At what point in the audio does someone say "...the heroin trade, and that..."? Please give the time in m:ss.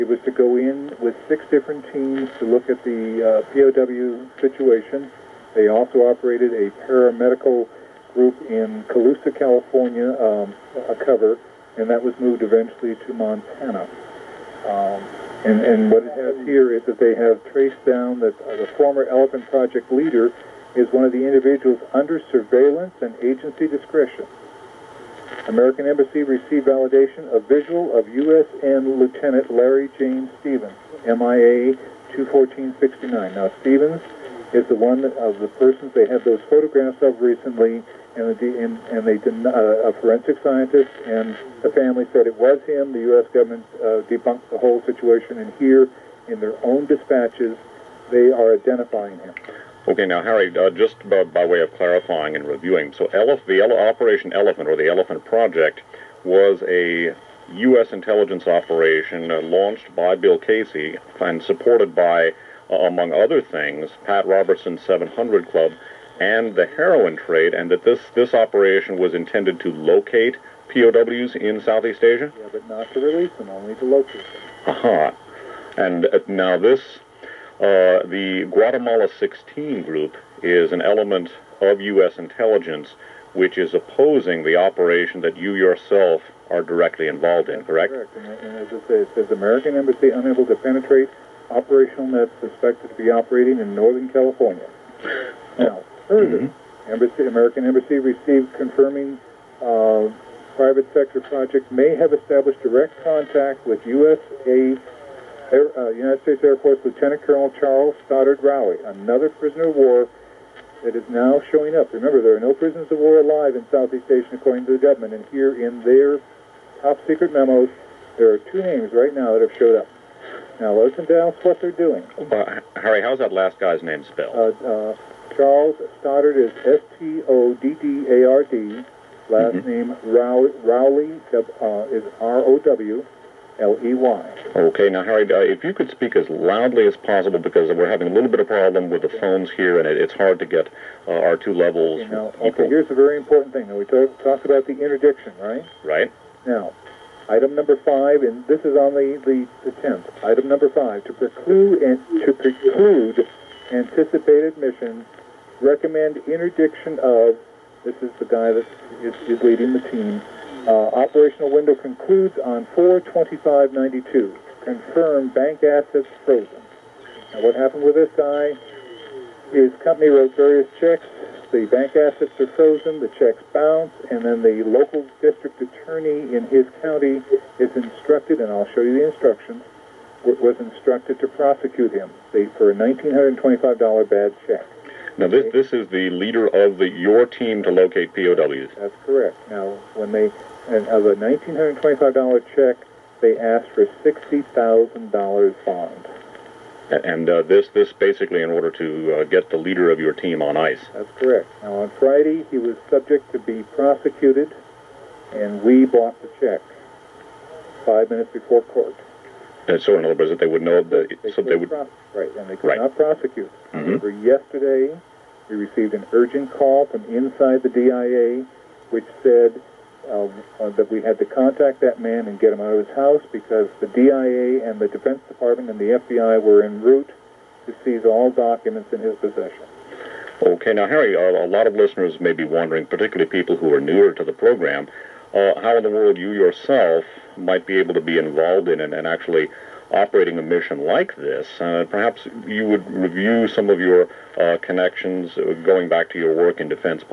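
1:06.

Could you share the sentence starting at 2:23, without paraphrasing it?
Now we talked talk about the interdiction, right?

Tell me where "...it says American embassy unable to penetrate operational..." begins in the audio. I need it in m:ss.
1:29.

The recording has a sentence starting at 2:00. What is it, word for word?
Now, listen down what they're doing.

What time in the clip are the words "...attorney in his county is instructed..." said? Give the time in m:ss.
2:55.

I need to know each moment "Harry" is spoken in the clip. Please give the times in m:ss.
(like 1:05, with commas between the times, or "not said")
0:50, 2:02, 2:15, 3:50.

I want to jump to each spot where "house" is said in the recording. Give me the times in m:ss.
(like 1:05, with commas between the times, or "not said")
3:42.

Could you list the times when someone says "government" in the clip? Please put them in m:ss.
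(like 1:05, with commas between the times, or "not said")
0:43, 1:54.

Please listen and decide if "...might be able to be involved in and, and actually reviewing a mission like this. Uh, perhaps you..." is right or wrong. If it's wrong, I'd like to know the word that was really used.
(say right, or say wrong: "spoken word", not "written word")
wrong: "operating", not "reviewing".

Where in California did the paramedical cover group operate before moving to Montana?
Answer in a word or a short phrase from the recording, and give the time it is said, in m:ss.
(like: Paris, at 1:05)
Colusa, at 0:08.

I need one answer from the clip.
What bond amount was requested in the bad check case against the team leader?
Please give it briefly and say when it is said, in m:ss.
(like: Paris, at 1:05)
$60,000, at 3:14.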